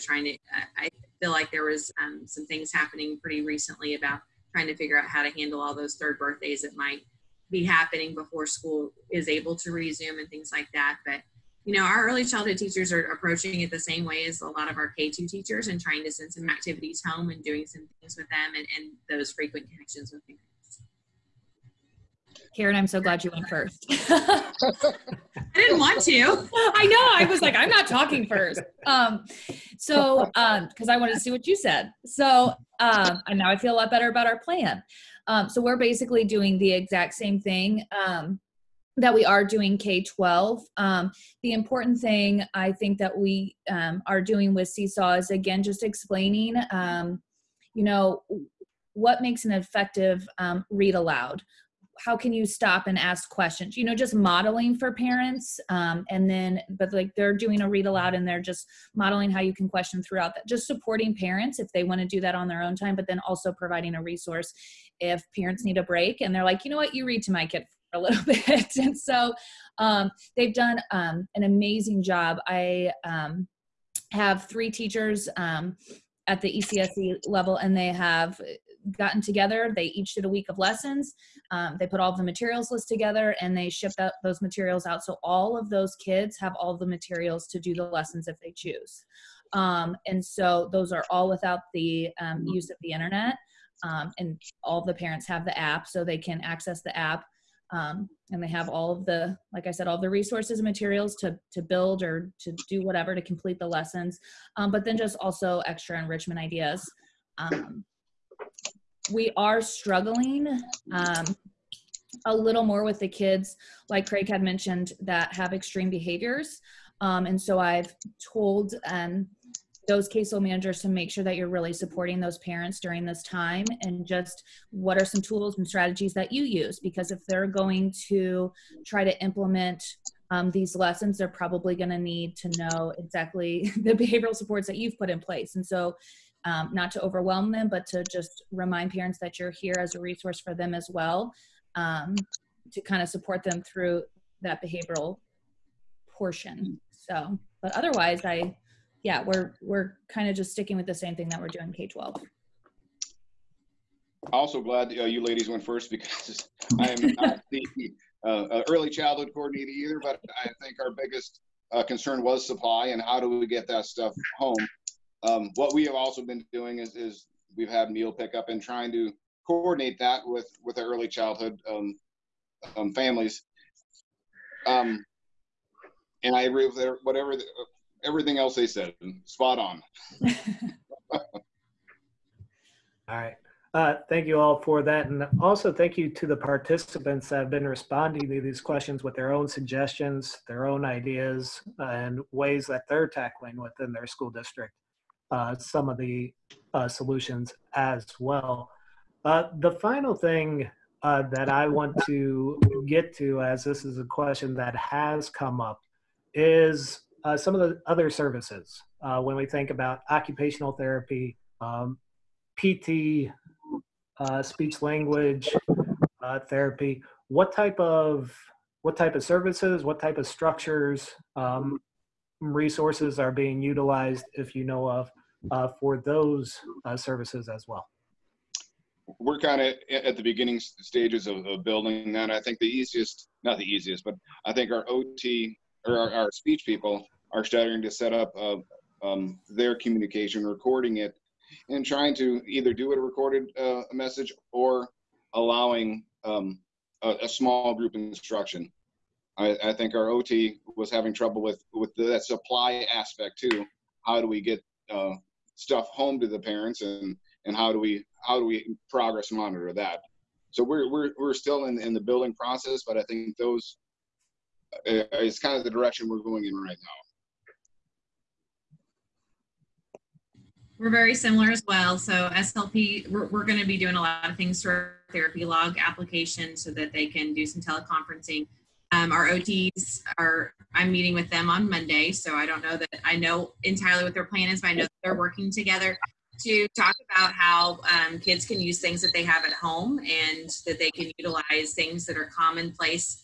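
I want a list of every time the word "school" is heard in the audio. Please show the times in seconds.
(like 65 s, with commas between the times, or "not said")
8 s, 194 s.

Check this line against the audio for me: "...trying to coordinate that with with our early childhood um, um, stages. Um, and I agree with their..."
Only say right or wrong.
wrong.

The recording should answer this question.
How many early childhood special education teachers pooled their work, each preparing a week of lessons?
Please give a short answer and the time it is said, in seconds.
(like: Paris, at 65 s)
3, at 74 s.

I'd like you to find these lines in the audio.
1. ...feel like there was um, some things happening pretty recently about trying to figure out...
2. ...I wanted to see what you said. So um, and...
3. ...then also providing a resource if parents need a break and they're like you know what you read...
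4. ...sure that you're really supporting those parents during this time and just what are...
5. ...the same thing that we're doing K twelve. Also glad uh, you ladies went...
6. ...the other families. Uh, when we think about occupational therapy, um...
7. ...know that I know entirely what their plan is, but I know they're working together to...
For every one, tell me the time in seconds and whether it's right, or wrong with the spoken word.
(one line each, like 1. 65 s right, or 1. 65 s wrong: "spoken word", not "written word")
1. 1 s right
2. 30 s right
3. 63 s right
4. 121 s right
5. 150 s right
6. 207 s wrong: "services", not "families"
7. 282 s right.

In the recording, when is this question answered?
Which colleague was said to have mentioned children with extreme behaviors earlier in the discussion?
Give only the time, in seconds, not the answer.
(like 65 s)
114 s.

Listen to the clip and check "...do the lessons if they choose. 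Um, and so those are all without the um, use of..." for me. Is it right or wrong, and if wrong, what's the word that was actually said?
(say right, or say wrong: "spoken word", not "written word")
right.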